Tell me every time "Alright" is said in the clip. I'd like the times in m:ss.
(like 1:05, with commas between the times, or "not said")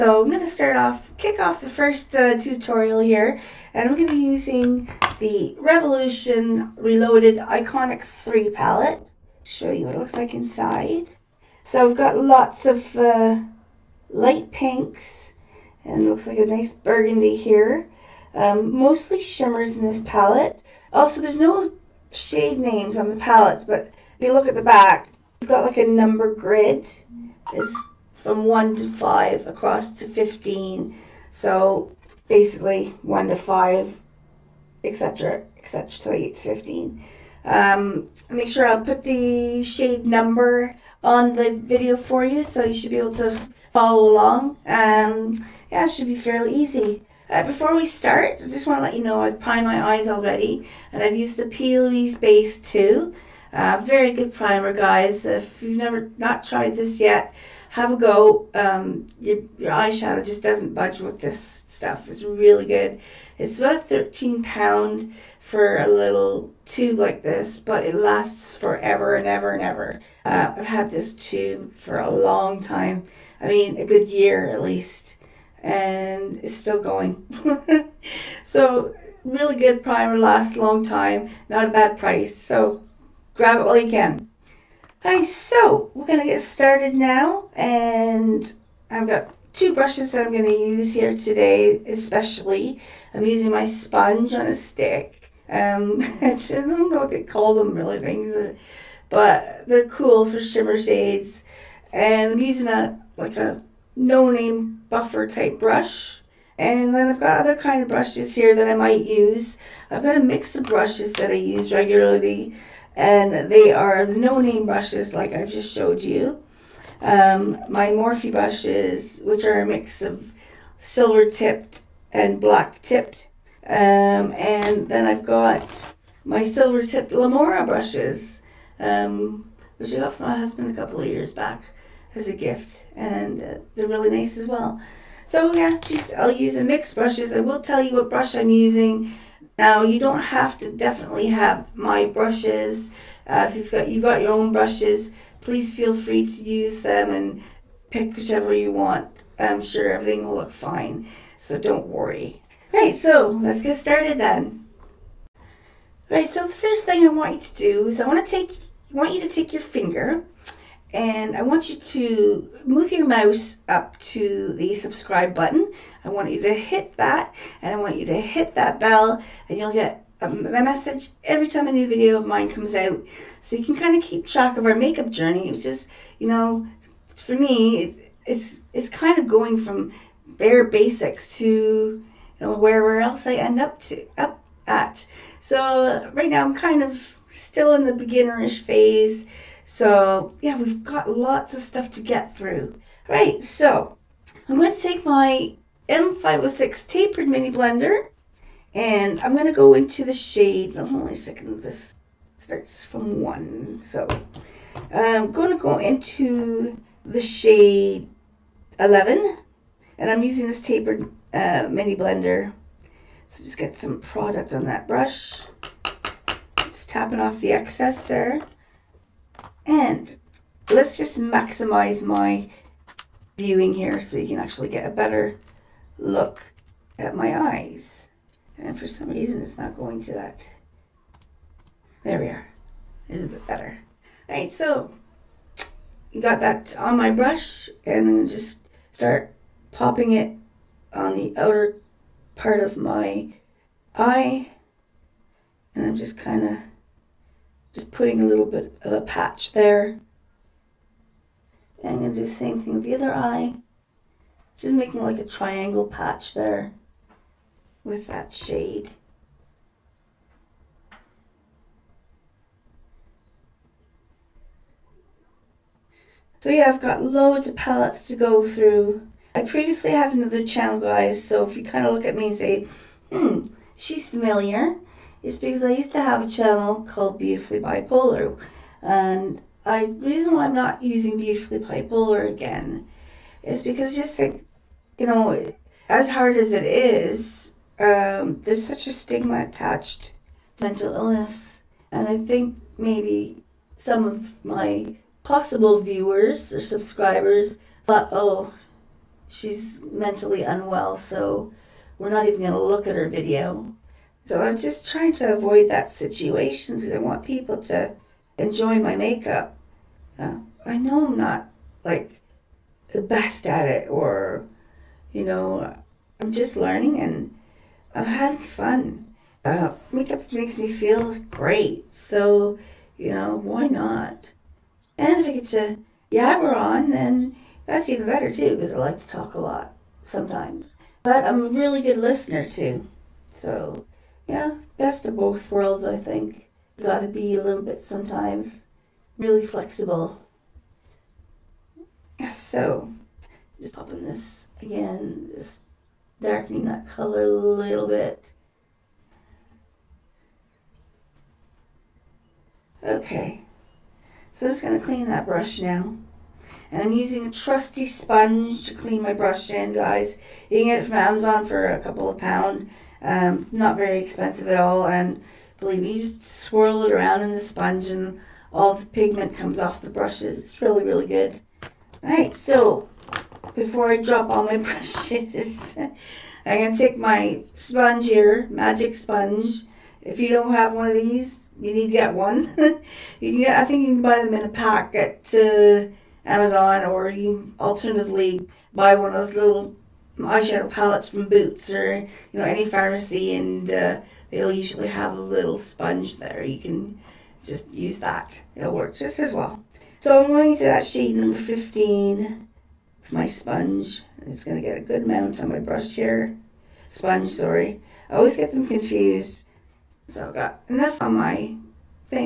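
1:25, 3:54, 6:12.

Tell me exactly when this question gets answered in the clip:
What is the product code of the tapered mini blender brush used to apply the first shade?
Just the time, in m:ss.
3:15.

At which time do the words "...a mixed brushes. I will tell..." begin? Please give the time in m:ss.
2:16.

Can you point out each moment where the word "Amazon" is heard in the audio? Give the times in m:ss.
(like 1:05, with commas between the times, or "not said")
6:00, 6:26.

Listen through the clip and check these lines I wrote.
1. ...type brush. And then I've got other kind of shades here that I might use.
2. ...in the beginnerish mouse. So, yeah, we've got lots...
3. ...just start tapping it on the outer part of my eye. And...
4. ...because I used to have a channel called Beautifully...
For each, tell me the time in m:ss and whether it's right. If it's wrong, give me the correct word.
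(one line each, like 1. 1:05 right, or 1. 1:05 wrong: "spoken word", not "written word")
1. 1:45 wrong: "brushes", not "shades"
2. 3:07 wrong: "phase", not "mouse"
3. 3:58 wrong: "popping", not "tapping"
4. 4:35 right.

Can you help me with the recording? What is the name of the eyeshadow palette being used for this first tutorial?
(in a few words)
Revolution Reloaded Iconic 3.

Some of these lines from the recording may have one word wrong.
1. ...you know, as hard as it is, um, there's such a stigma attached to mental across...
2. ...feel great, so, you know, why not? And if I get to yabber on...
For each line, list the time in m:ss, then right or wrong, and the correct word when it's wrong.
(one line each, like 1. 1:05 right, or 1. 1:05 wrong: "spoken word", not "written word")
1. 4:44 wrong: "illness", not "across"
2. 5:20 right.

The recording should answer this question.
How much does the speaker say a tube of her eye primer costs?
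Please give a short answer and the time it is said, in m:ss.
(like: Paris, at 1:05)
13 pounds, at 1:03.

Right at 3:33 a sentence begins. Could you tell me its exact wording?
So just get some product on that brush.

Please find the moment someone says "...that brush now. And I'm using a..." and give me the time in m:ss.
5:55.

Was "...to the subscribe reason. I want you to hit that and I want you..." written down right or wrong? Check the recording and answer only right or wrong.
wrong.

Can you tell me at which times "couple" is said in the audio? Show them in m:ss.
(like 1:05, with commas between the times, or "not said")
2:10, 6:01.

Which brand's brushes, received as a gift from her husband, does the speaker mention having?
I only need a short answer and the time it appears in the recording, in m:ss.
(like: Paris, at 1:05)
Lamora, at 2:07.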